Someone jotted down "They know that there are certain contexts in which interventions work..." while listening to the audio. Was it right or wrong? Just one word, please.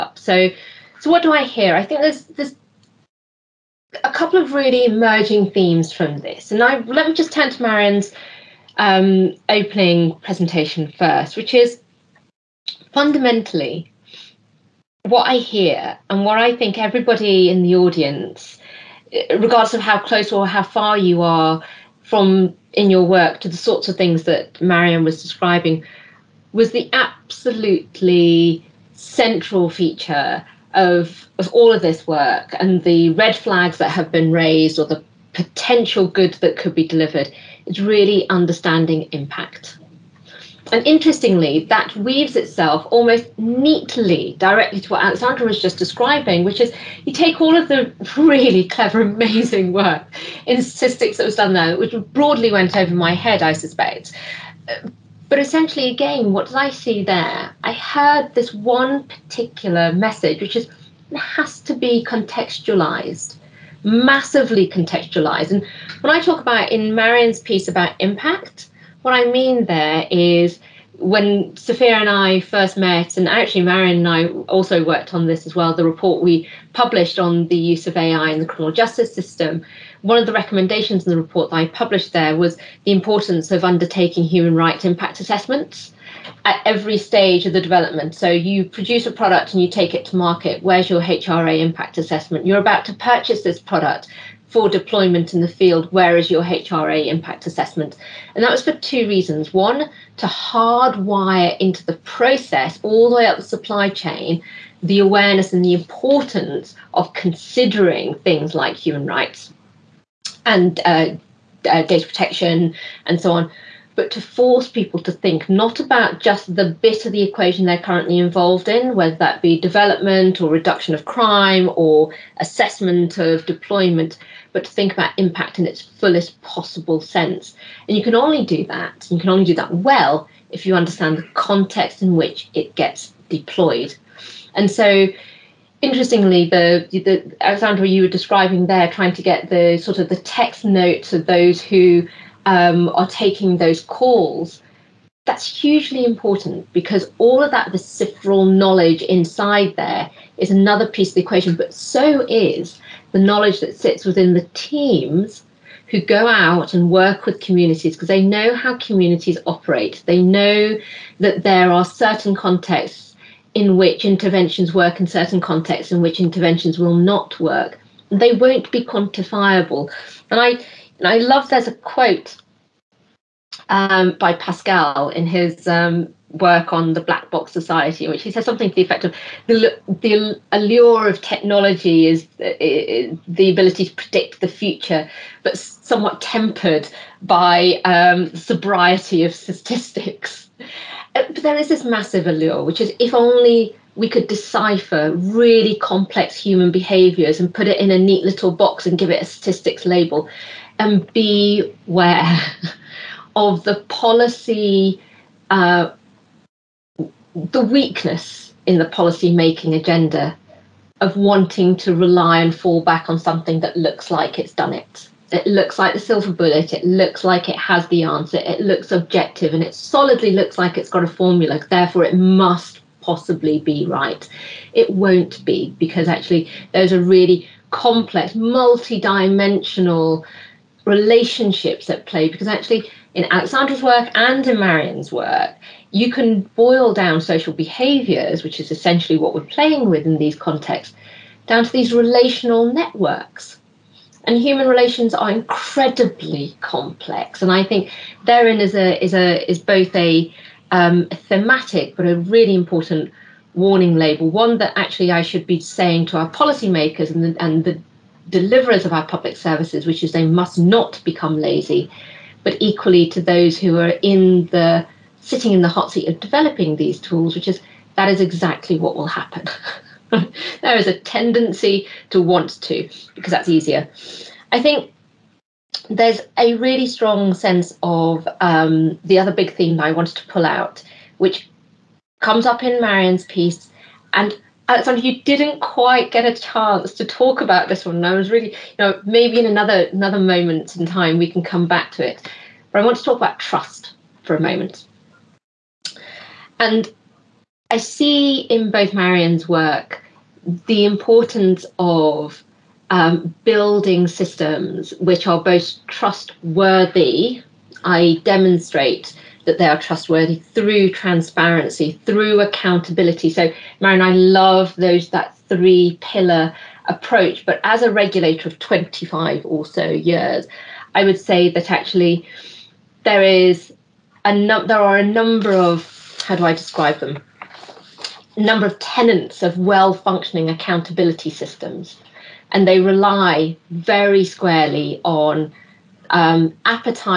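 right.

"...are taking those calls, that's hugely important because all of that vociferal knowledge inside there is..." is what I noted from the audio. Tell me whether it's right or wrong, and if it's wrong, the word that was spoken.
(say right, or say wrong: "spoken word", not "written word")
right.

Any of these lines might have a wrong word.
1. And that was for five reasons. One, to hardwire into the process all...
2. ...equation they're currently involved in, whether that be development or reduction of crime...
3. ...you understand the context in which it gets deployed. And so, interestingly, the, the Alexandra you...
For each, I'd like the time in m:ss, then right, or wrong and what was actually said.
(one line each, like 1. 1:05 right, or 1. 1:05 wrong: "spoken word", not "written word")
1. 1:38 wrong: "two", not "five"
2. 1:57 right
3. 2:10 right.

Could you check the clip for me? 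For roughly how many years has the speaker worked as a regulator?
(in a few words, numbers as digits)
25.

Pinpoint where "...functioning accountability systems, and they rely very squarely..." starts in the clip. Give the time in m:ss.
5:29.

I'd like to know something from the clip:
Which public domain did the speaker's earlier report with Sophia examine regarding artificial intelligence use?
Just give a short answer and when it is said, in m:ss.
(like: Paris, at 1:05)
criminal justice system, at 1:18.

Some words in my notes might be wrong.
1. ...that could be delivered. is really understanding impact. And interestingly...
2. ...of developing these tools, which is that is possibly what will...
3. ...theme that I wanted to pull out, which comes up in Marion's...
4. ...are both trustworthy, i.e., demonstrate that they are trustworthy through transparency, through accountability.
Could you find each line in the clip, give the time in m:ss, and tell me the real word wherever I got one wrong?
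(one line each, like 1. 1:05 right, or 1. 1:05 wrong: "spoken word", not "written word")
1. 0:36 right
2. 4:26 wrong: "exactly", not "possibly"
3. 4:39 right
4. 5:05 right.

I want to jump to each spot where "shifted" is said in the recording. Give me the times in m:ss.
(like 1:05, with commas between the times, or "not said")
not said.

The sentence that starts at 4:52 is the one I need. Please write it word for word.
But I want to talk about trust for a moment.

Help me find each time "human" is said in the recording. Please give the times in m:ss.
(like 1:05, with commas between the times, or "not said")
1:24, 1:48, 3:16, 4:04.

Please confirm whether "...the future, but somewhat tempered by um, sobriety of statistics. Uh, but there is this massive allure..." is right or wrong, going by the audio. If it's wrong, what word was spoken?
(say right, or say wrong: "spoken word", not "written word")
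right.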